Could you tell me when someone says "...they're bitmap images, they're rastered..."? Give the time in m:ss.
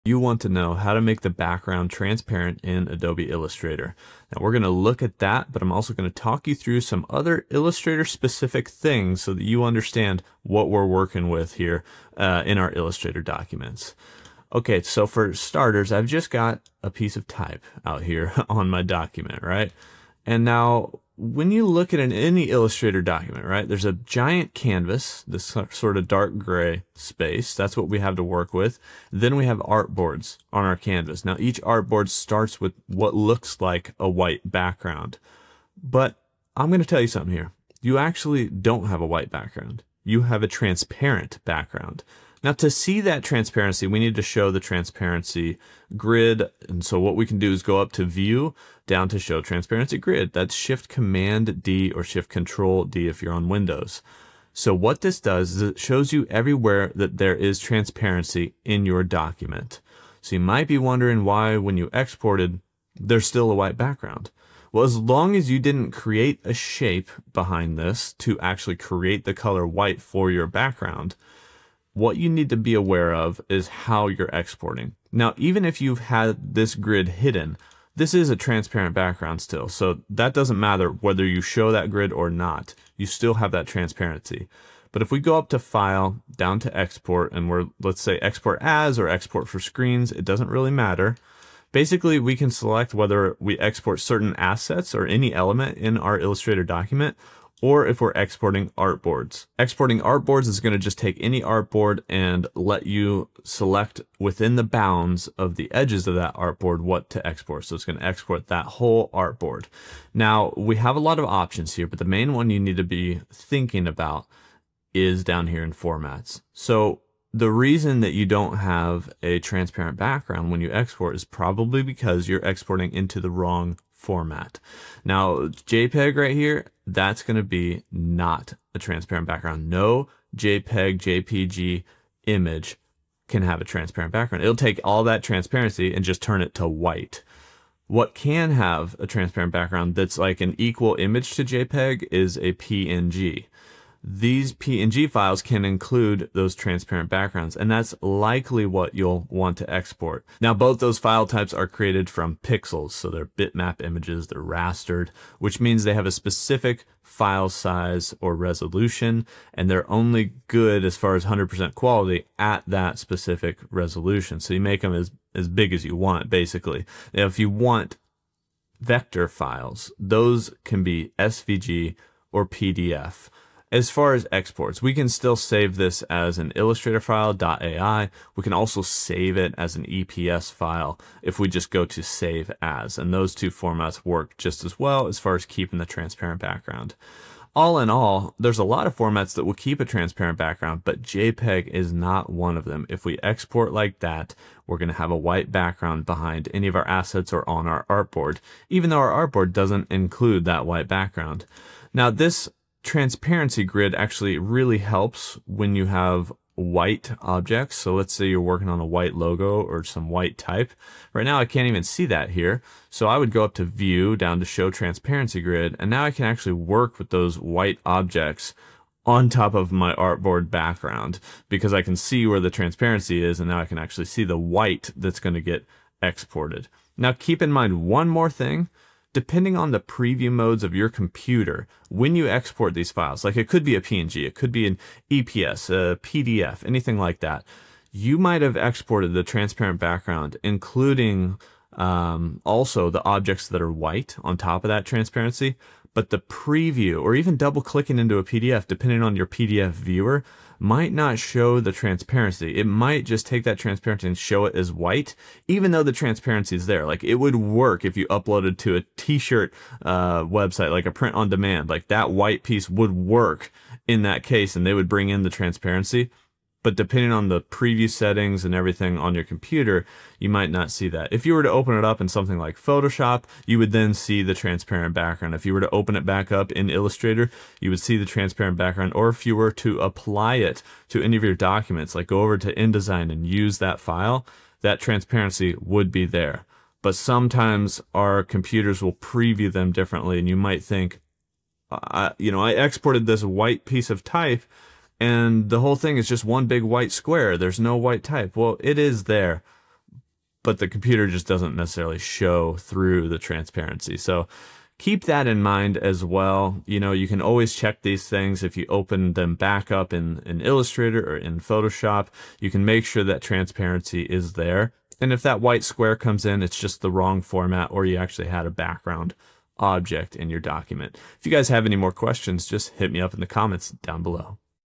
2:33.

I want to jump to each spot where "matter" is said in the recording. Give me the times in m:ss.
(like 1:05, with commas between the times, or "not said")
1:20, 1:30.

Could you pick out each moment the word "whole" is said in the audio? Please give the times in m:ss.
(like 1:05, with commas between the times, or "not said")
1:48, 4:55.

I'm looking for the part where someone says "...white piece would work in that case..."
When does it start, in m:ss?
4:22.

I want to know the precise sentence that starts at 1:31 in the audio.
Basically, we can select whether we export certain assets or any element in our Illustrator document, or if we're exporting artboards.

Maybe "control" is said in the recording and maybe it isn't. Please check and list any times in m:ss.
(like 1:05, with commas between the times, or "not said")
0:52.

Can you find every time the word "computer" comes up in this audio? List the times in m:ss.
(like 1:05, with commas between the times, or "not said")
3:50, 4:29, 4:48, 5:00.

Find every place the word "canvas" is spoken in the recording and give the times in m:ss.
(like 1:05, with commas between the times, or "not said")
0:24, 0:30.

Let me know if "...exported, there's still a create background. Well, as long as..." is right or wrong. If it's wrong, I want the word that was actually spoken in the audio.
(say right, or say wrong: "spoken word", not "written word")
wrong: "white", not "create".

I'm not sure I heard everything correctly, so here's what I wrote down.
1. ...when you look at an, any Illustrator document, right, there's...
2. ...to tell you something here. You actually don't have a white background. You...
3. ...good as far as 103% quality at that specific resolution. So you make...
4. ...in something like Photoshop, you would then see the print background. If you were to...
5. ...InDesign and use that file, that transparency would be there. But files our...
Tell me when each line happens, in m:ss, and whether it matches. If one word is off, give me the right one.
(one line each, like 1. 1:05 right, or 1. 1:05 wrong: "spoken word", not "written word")
1. 0:21 right
2. 0:36 right
3. 2:40 wrong: "100", not "103"
4. 4:31 wrong: "transparent", not "print"
5. 4:42 wrong: "sometimes", not "files".